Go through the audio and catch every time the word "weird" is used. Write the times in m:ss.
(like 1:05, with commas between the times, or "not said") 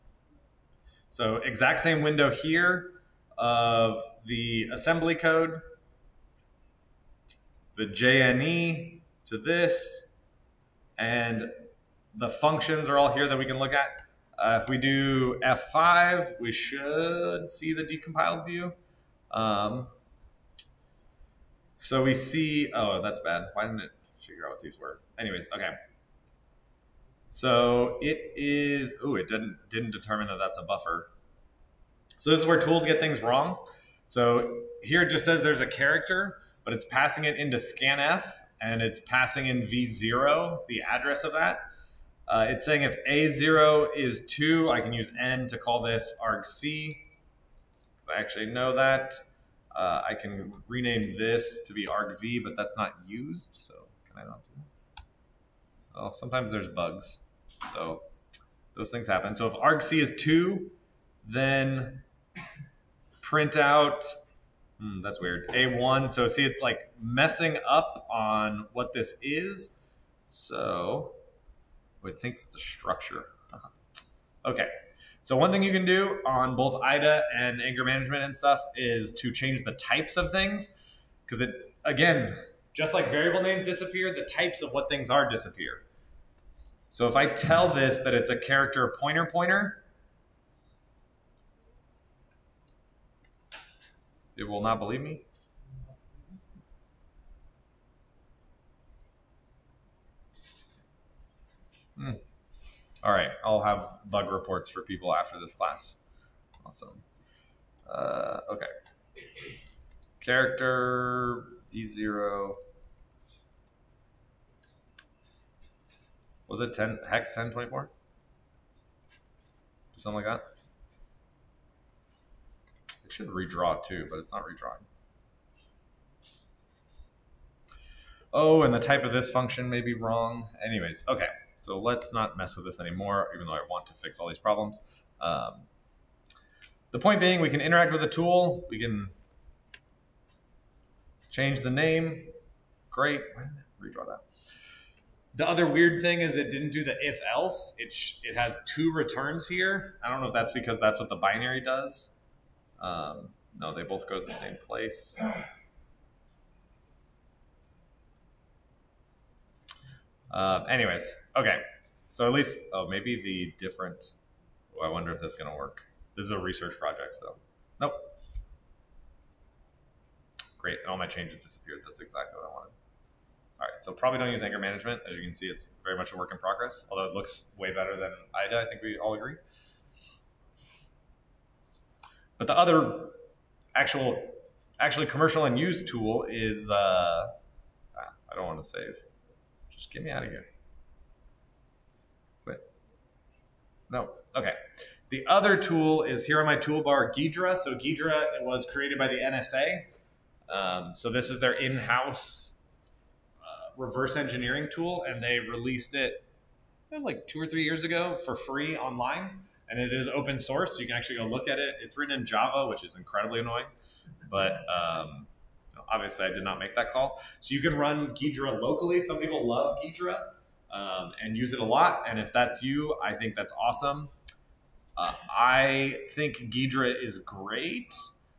1:05, 2:25.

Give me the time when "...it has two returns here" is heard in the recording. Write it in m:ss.
2:28.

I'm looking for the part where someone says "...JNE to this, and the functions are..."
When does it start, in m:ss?
0:07.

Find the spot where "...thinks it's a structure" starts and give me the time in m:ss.
1:12.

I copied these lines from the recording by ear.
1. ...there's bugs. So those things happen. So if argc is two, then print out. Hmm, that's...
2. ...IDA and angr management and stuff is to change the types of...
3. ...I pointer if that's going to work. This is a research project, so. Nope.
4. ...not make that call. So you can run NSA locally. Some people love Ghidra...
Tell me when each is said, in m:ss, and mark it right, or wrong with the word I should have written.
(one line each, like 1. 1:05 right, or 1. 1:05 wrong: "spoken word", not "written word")
1. 0:56 right
2. 1:16 right
3. 2:44 wrong: "wonder", not "pointer"
4. 3:36 wrong: "Ghidra", not "NSA".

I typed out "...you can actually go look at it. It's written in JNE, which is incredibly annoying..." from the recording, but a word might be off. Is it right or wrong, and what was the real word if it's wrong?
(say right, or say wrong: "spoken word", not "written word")
wrong: "Java", not "JNE".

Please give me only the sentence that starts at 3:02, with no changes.
But the other actual, actually commercial and used tool is, uh, ah, I don't want to save.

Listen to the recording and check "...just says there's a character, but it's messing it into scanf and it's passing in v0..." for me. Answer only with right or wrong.
wrong.